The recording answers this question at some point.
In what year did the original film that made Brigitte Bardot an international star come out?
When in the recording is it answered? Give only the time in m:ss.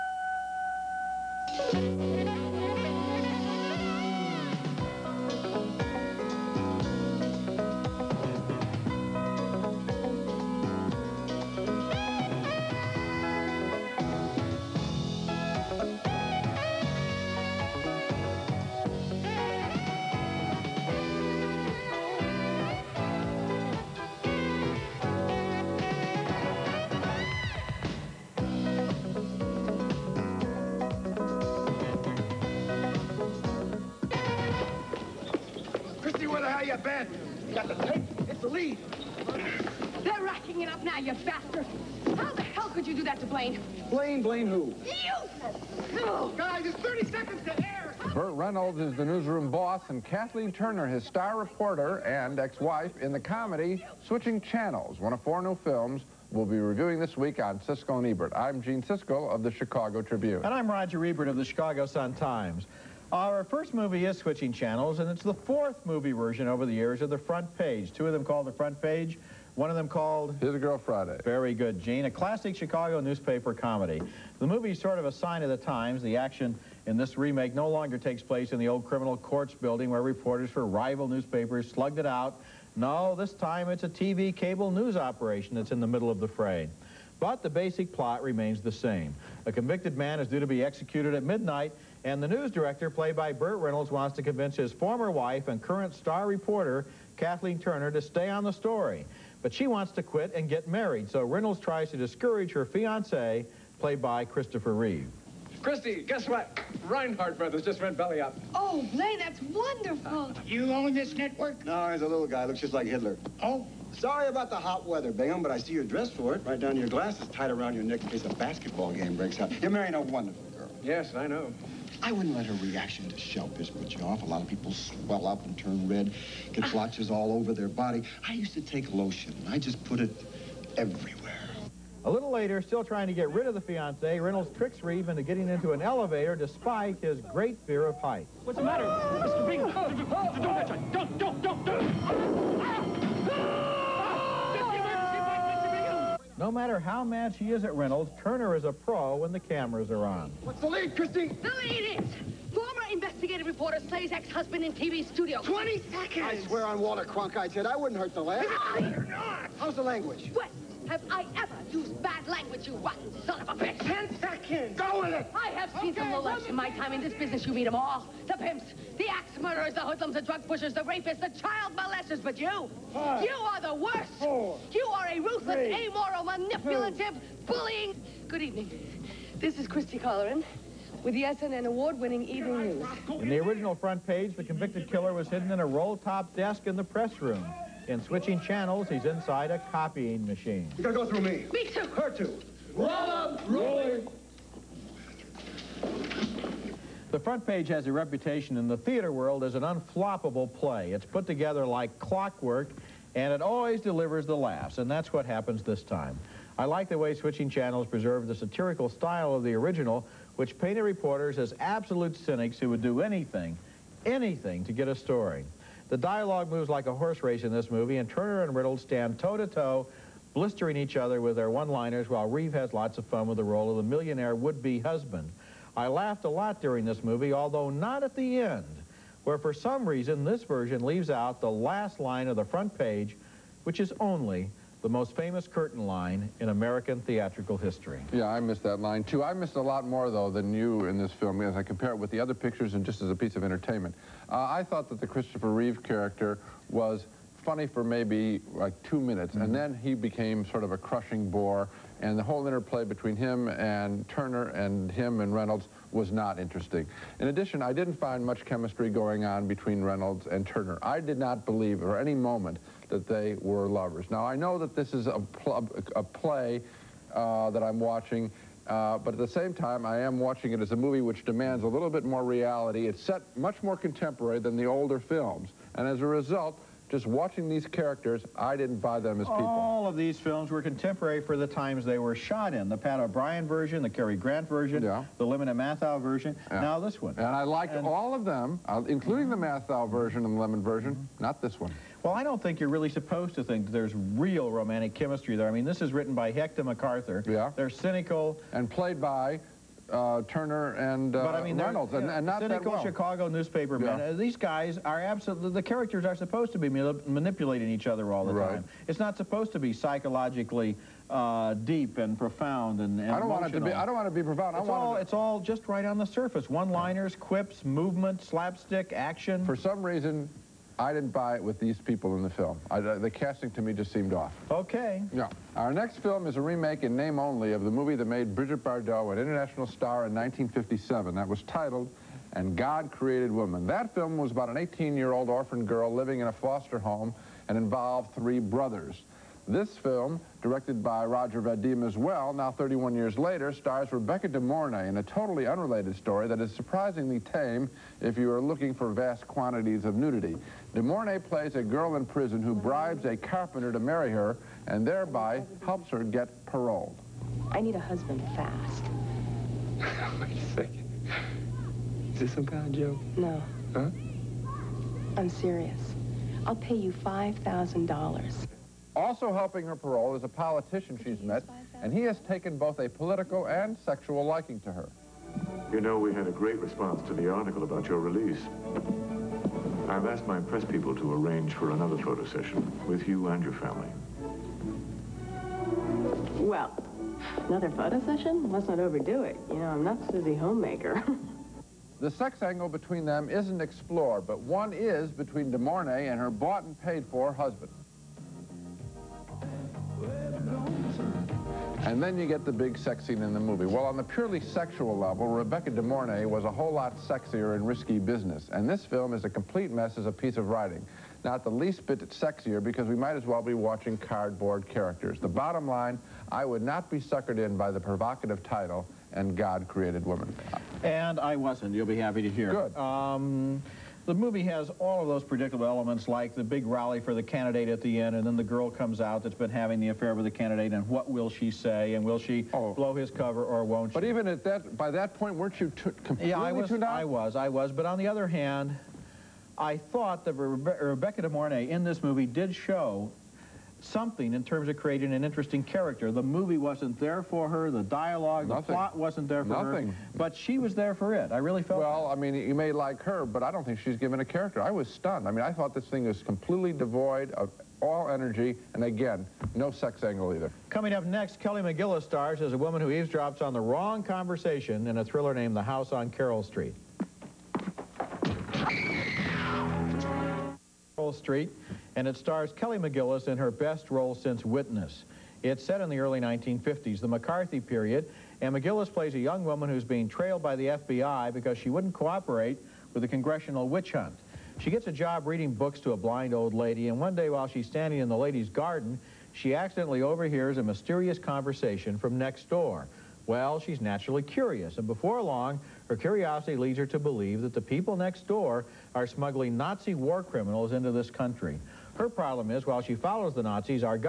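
5:30.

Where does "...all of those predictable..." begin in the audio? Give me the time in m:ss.
7:04.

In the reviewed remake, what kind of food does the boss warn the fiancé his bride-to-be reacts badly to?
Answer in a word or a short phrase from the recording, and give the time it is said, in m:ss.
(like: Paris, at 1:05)
shellfish, at 2:03.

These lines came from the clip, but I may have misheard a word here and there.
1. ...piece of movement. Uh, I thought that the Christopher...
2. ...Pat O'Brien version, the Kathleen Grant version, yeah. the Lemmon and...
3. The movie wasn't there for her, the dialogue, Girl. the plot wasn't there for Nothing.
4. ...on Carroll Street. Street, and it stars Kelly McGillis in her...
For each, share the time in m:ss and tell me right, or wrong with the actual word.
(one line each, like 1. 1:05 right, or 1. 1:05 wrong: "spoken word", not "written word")
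1. 4:03 wrong: "entertainment", not "movement"
2. 4:42 wrong: "Cary", not "Kathleen"
3. 7:26 wrong: "Nothing", not "Girl"
4. 7:45 right.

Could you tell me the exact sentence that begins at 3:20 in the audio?
It's put together like clockwork, and it always delivers the laughs, and that's what happens this time.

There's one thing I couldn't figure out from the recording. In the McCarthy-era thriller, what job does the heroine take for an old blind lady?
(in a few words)
reading books.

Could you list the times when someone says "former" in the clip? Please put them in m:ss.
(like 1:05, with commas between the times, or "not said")
1:34, 2:32.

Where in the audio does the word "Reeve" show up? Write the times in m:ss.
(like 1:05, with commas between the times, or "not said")
1:44, 2:14, 3:42, 4:05.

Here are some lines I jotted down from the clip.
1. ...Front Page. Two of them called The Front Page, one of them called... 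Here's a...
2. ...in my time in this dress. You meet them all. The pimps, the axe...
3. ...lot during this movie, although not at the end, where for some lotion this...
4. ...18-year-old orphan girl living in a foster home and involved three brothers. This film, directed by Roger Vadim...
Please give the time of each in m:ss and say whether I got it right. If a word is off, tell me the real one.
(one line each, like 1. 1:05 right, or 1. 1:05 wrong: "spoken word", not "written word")
1. 1:07 right
2. 2:46 wrong: "business", not "dress"
3. 3:46 wrong: "reason", not "lotion"
4. 5:34 right.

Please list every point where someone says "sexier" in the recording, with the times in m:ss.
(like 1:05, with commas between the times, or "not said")
6:46, 6:52.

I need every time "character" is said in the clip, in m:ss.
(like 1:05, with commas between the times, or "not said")
4:05, 4:37, 5:05, 6:54, 7:25, 7:34.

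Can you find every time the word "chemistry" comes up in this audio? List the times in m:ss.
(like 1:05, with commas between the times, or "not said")
4:18, 4:54.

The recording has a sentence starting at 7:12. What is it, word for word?
blow his cover or won't she?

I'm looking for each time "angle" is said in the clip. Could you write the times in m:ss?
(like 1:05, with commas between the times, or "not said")
6:32, 7:40.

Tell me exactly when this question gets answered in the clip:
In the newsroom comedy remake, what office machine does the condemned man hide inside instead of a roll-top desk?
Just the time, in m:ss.
3:09.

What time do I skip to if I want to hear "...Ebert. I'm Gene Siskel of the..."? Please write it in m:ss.
0:58.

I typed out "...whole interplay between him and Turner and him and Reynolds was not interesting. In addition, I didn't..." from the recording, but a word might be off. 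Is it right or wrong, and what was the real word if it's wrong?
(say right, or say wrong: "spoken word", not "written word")
right.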